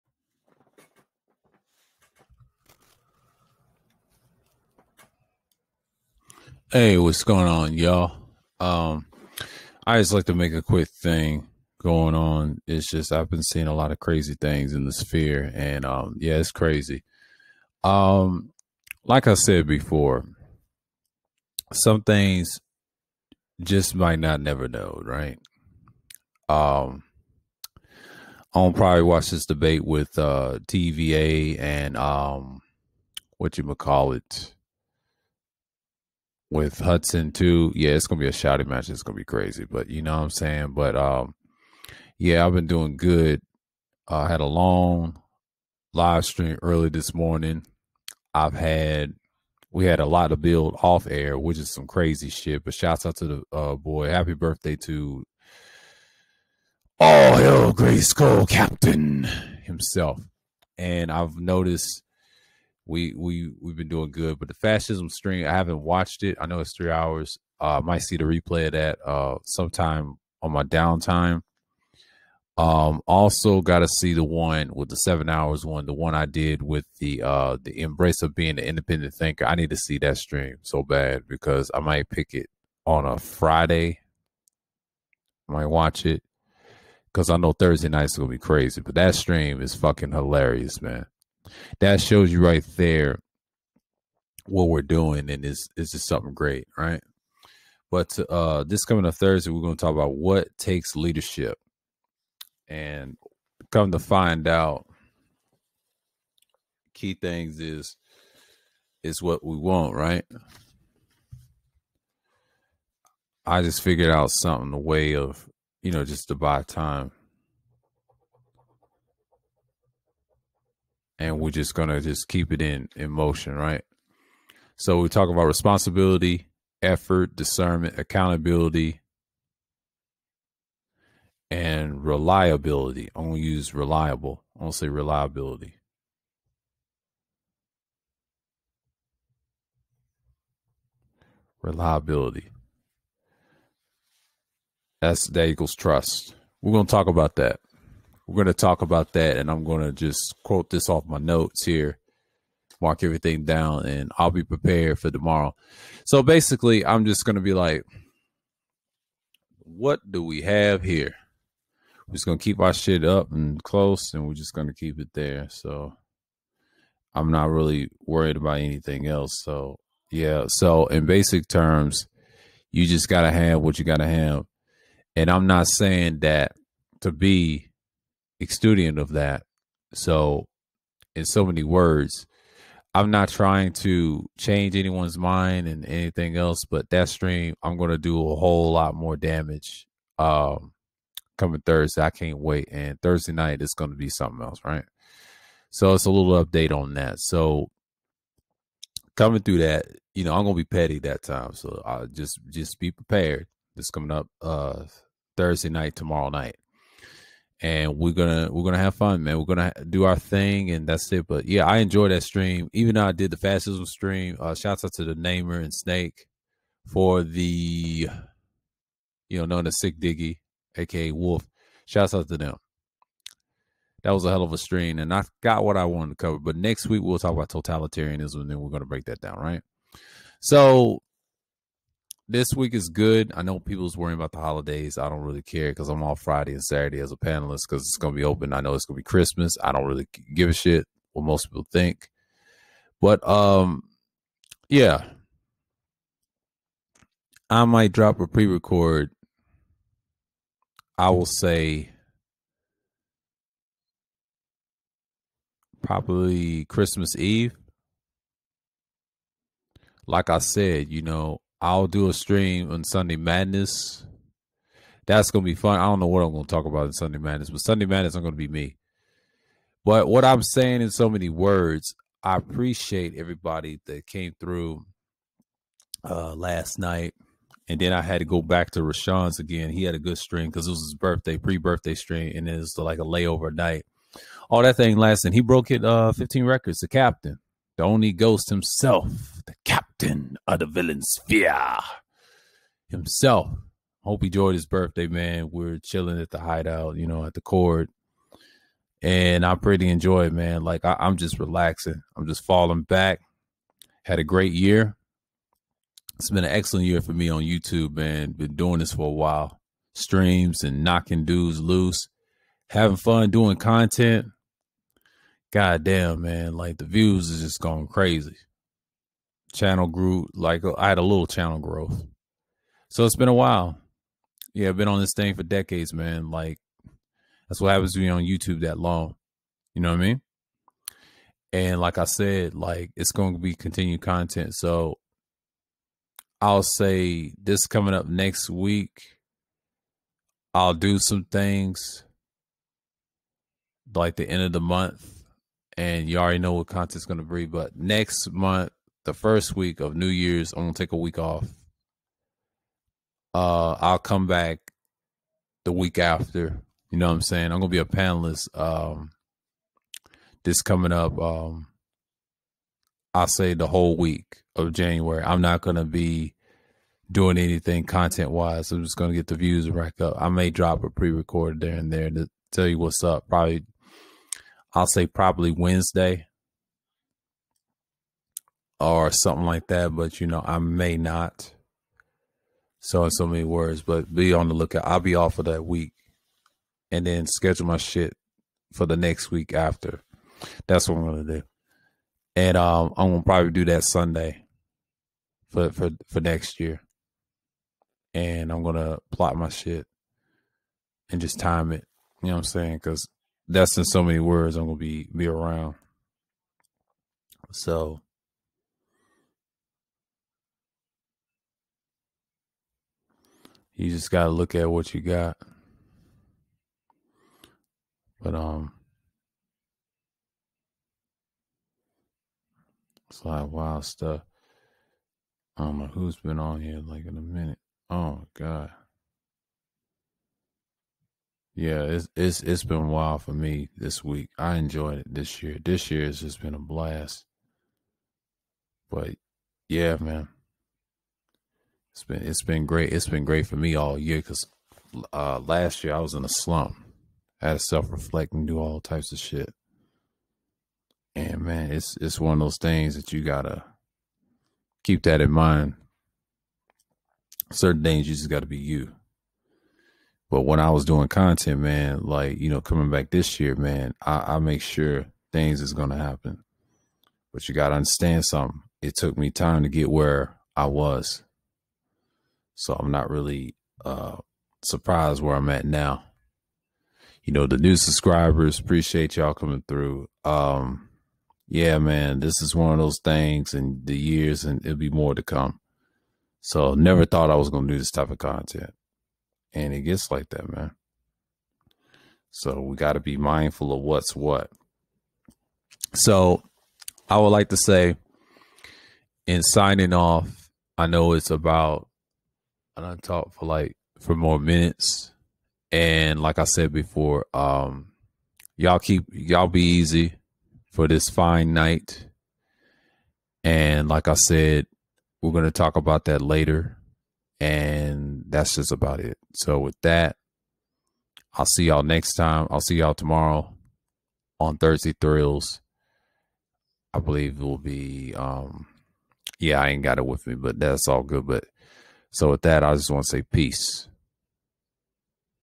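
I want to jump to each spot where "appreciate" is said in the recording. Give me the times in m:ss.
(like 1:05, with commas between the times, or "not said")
4:32, 7:58.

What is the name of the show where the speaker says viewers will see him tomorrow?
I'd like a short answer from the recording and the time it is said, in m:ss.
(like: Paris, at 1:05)
Thursday Thrills, at 8:44.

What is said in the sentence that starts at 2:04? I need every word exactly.
So we talk about responsibility, effort, discernment, accountability, and reliability.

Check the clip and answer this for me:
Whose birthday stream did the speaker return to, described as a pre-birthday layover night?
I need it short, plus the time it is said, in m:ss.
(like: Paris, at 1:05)
Rashawn, at 4:38.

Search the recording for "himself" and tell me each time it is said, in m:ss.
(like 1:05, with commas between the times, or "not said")
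0:59, 4:48, 4:52.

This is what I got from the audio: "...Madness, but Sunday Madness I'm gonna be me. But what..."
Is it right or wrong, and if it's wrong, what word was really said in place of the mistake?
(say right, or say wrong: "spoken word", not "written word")
right.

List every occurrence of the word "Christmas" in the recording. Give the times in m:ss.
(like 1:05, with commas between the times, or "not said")
3:59, 4:16.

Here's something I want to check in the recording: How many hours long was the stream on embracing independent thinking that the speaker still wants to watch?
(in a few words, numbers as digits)
7.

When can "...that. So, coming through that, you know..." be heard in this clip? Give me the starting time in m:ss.
3:16.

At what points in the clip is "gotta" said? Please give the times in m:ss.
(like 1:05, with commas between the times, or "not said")
7:33, 7:38, 7:47.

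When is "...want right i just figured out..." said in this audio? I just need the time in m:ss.
1:49.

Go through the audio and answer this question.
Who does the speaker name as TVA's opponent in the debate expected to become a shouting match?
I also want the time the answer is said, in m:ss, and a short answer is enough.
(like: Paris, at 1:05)
Hudson, at 0:36.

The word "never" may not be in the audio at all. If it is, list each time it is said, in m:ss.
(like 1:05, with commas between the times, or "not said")
0:24, 8:06.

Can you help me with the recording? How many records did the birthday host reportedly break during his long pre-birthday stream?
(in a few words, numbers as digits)
15.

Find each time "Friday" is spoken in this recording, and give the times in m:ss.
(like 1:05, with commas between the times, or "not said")
1:23, 3:56.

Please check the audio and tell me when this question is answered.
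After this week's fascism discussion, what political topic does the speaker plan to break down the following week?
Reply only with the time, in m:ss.
3:47.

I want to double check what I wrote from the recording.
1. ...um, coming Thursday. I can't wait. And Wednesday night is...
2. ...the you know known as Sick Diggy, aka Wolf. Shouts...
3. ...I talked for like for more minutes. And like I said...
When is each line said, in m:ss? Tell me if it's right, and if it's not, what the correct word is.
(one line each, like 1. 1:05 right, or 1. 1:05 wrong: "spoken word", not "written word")
1. 3:10 wrong: "Thursday", not "Wednesday"
2. 3:37 right
3. 8:22 right.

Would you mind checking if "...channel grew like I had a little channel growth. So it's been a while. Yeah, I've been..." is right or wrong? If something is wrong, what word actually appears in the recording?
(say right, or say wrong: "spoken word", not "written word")
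right.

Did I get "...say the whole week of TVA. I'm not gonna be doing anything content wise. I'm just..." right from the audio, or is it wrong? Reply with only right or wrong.
wrong.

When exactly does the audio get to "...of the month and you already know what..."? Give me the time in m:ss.
5:44.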